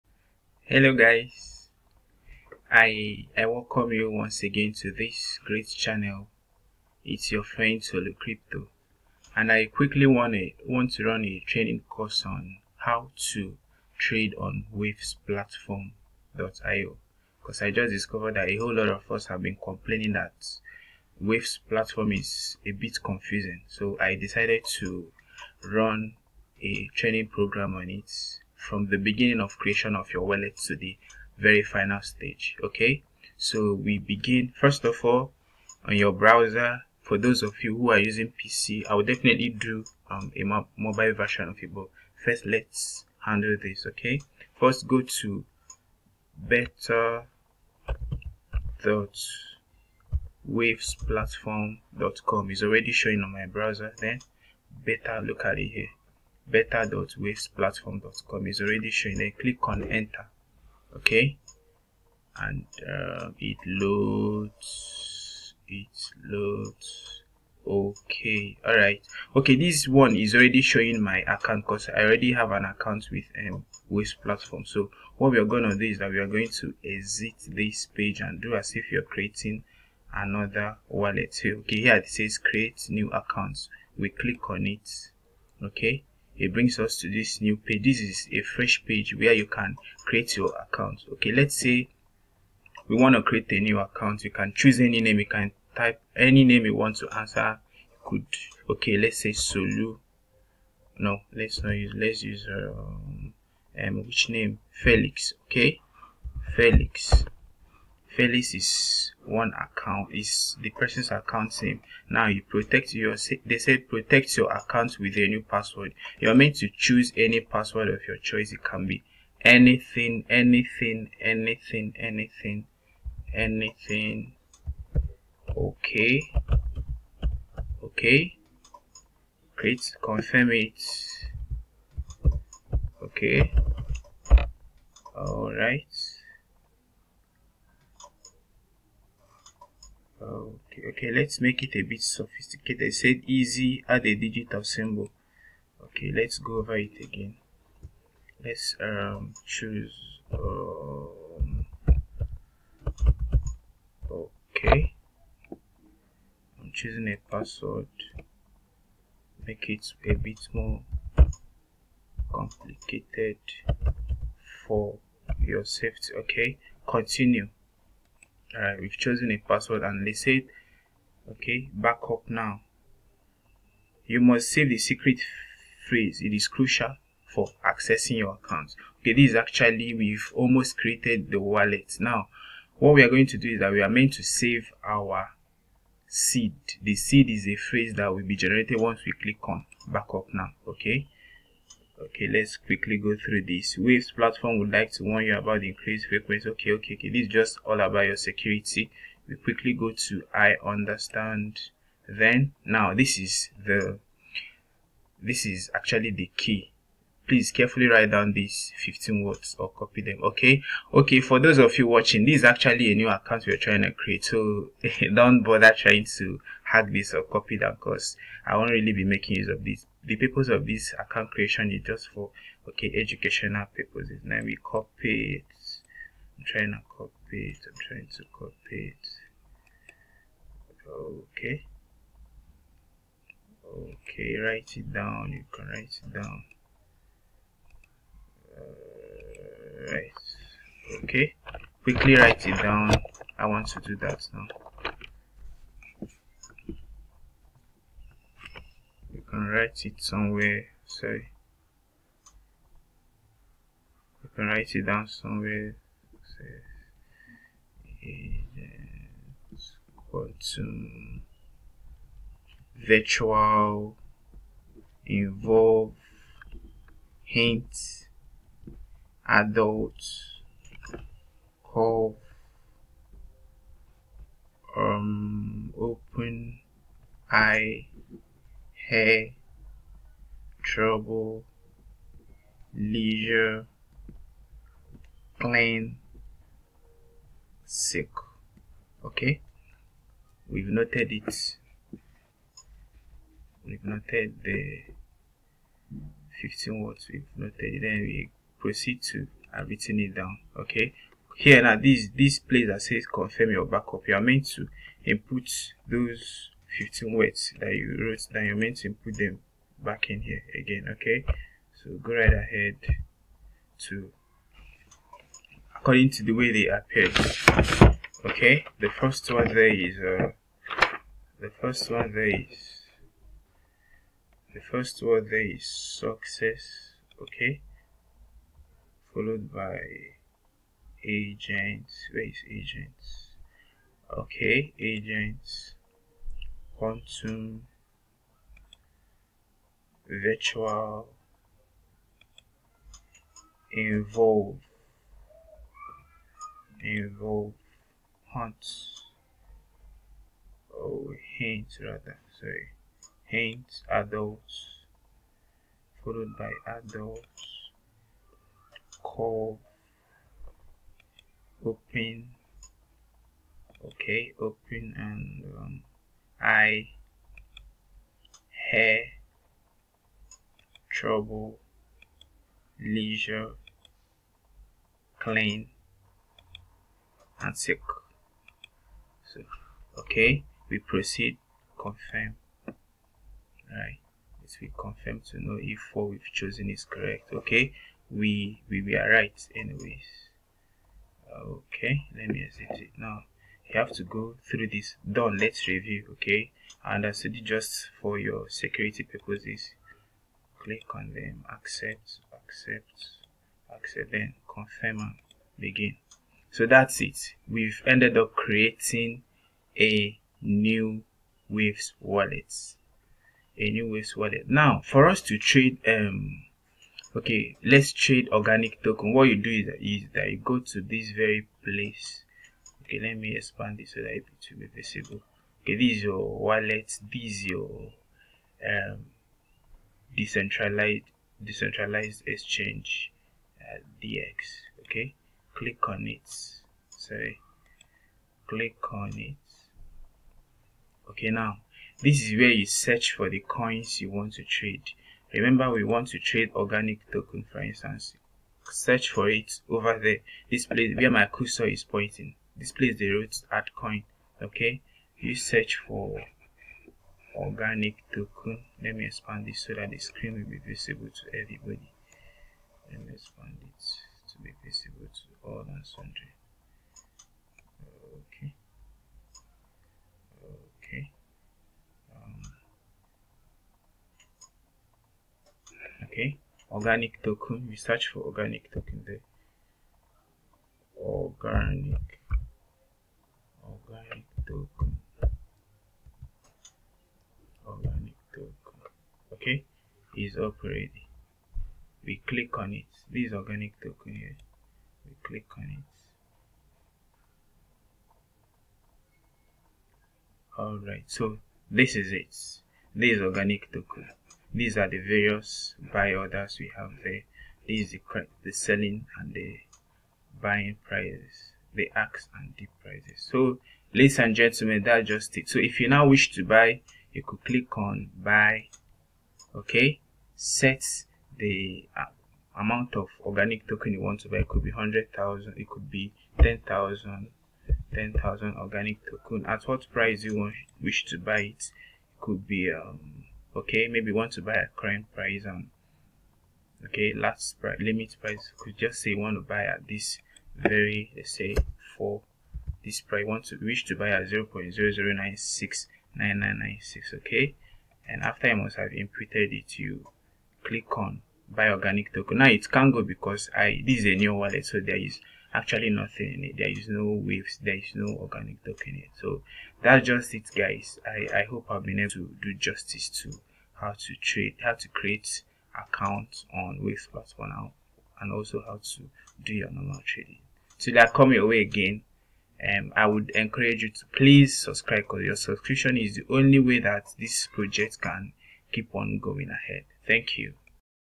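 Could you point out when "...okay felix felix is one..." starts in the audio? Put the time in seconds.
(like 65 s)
105 s.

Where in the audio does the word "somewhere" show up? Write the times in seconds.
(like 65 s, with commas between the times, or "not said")
250 s, 255 s.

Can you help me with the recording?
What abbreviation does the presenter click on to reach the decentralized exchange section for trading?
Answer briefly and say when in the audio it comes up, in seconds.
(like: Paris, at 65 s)
DX, at 434 s.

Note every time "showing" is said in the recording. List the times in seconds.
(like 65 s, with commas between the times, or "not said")
52 s, 58 s, 70 s.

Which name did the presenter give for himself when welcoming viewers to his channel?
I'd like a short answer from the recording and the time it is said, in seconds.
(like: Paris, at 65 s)
Solo Crypto, at 7 s.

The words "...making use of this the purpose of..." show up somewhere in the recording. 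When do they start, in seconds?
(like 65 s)
219 s.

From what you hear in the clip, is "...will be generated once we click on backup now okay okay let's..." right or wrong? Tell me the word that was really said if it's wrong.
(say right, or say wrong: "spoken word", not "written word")
right.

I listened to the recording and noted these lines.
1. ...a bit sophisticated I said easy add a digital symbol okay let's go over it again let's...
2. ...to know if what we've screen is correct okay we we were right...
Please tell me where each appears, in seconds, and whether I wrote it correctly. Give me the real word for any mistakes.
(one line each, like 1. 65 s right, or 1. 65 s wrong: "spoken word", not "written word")
1. 141 s right
2. 385 s wrong: "chosen", not "screen".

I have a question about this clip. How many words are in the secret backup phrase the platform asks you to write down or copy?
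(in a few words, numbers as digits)
15.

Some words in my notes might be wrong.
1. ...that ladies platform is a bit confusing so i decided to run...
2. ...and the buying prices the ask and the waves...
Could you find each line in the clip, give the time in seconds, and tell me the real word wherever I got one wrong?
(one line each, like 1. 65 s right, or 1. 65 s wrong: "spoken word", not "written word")
1. 20 s wrong: "waves", not "ladies"
2. 509 s wrong: "prices", not "waves".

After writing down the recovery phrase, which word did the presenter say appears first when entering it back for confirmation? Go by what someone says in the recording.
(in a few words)
success.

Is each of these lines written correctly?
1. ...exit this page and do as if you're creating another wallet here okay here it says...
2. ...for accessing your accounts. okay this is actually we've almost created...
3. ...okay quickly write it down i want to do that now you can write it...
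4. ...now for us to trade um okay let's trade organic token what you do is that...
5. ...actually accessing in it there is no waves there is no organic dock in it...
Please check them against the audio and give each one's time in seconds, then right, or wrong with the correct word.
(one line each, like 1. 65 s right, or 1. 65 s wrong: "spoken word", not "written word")
1. 76 s right
2. 177 s right
3. 241 s right
4. 414 s right
5. 555 s wrong: "nothing", not "accessing".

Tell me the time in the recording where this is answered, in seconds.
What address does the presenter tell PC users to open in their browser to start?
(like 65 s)
56 s.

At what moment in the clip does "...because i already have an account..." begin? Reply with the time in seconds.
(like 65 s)
71 s.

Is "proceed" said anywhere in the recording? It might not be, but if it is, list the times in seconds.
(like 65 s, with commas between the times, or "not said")
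298 s, 380 s.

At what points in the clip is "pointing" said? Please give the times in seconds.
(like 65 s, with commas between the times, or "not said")
451 s.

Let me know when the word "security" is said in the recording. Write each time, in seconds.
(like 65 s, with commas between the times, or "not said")
198 s, 398 s.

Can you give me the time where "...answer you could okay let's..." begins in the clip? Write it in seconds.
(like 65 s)
97 s.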